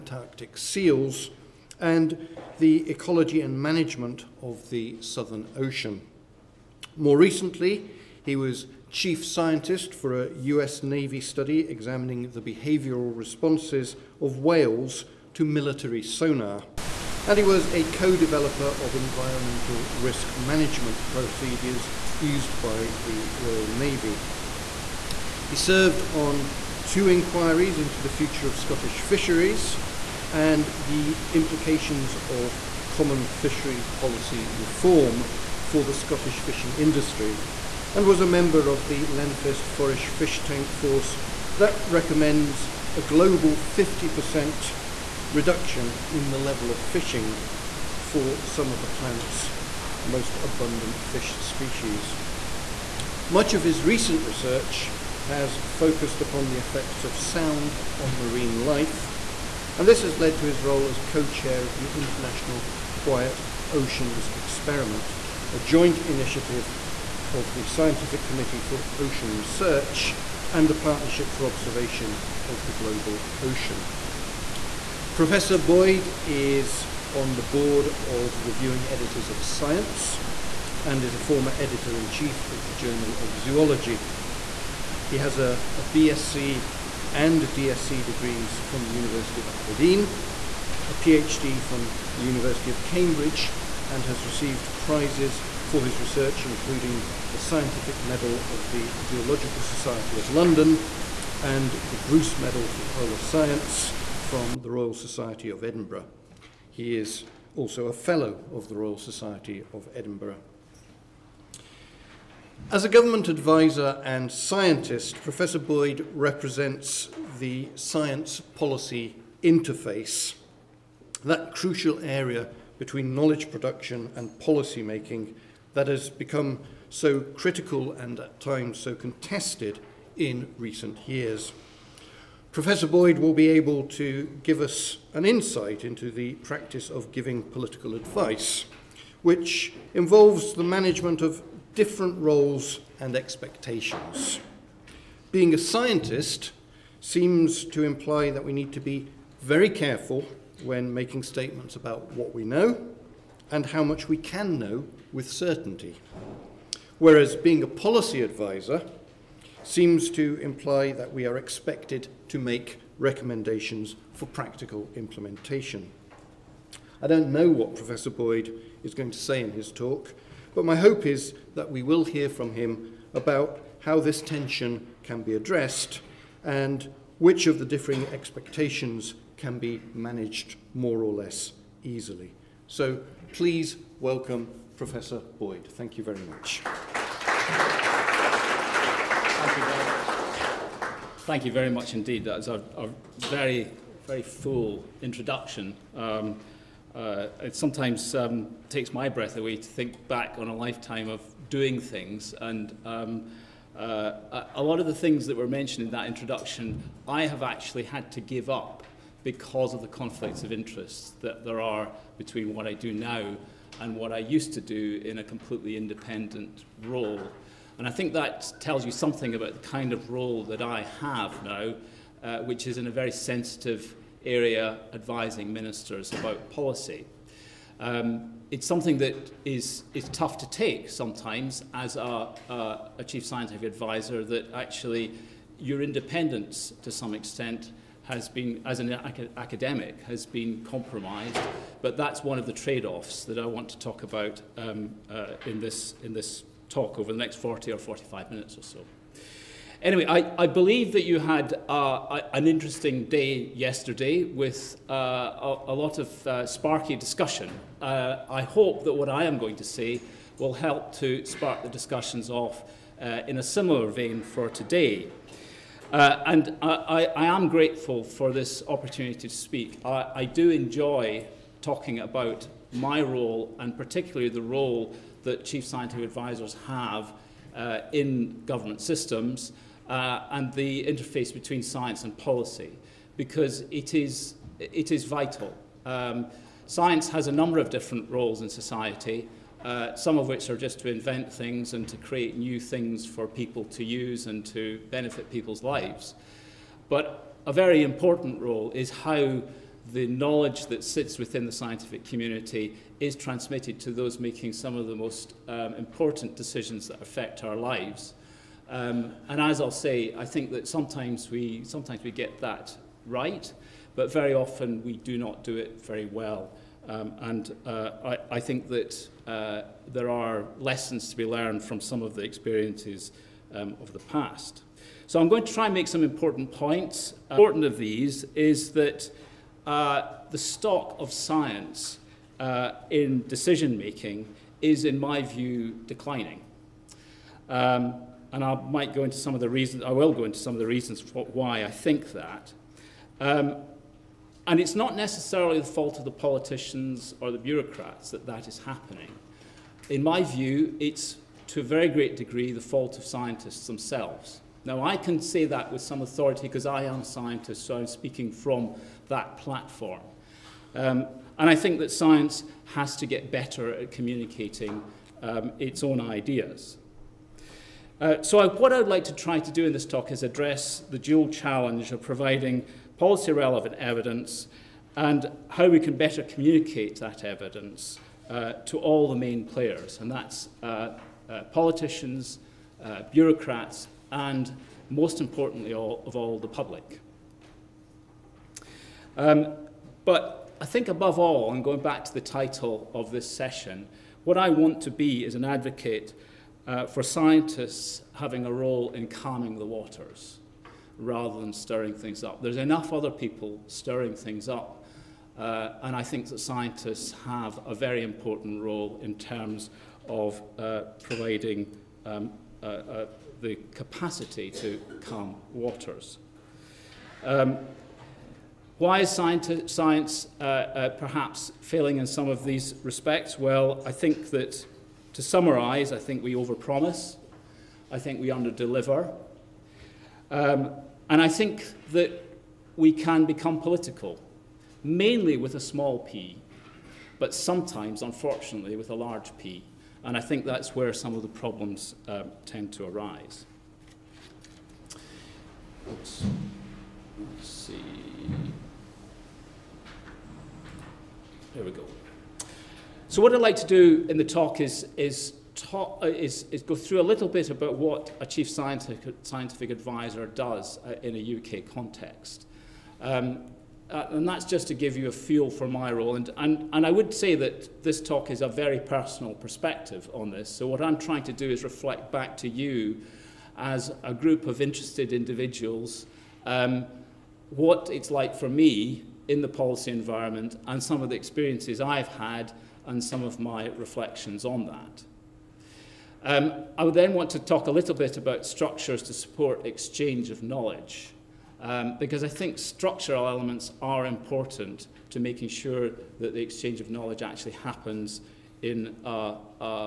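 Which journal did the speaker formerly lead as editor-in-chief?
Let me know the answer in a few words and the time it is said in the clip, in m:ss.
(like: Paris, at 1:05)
Journal of Zoology, at 1:22.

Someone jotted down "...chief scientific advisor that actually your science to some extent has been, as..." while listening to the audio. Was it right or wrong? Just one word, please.
wrong.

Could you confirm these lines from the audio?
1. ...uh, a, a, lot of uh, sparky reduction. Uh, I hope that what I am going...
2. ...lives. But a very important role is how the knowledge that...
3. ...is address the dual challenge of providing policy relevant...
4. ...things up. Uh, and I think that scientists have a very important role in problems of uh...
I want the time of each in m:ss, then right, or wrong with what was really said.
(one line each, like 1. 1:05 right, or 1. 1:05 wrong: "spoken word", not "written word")
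1. 4:14 wrong: "discussion", not "reduction"
2. 4:55 right
3. 6:10 right
4. 6:44 wrong: "terms", not "problems".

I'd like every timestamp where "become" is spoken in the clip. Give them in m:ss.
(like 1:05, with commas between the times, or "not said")
2:06, 7:13.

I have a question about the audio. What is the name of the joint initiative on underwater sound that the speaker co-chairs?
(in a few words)
International Quiet Oceans Experiment.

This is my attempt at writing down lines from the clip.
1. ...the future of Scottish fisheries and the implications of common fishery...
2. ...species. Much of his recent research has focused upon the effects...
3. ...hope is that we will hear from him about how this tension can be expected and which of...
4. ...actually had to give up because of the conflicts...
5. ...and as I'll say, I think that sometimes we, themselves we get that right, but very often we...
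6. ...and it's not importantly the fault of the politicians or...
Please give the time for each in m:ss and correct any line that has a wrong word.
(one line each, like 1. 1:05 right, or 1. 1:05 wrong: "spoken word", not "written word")
1. 0:28 right
2. 0:51 right
3. 2:50 wrong: "addressed", not "expected"
4. 3:27 right
5. 5:09 wrong: "sometimes", not "themselves"
6. 5:44 wrong: "necessarily", not "importantly".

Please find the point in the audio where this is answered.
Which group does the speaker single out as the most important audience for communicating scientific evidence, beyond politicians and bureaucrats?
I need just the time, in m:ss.
6:26.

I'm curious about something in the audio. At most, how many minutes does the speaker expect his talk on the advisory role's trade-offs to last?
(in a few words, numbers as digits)
45.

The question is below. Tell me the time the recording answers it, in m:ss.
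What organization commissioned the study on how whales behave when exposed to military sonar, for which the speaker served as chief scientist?
0:10.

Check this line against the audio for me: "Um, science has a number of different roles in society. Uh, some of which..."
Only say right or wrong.
right.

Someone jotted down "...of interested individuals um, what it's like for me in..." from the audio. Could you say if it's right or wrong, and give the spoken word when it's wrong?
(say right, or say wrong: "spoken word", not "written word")
right.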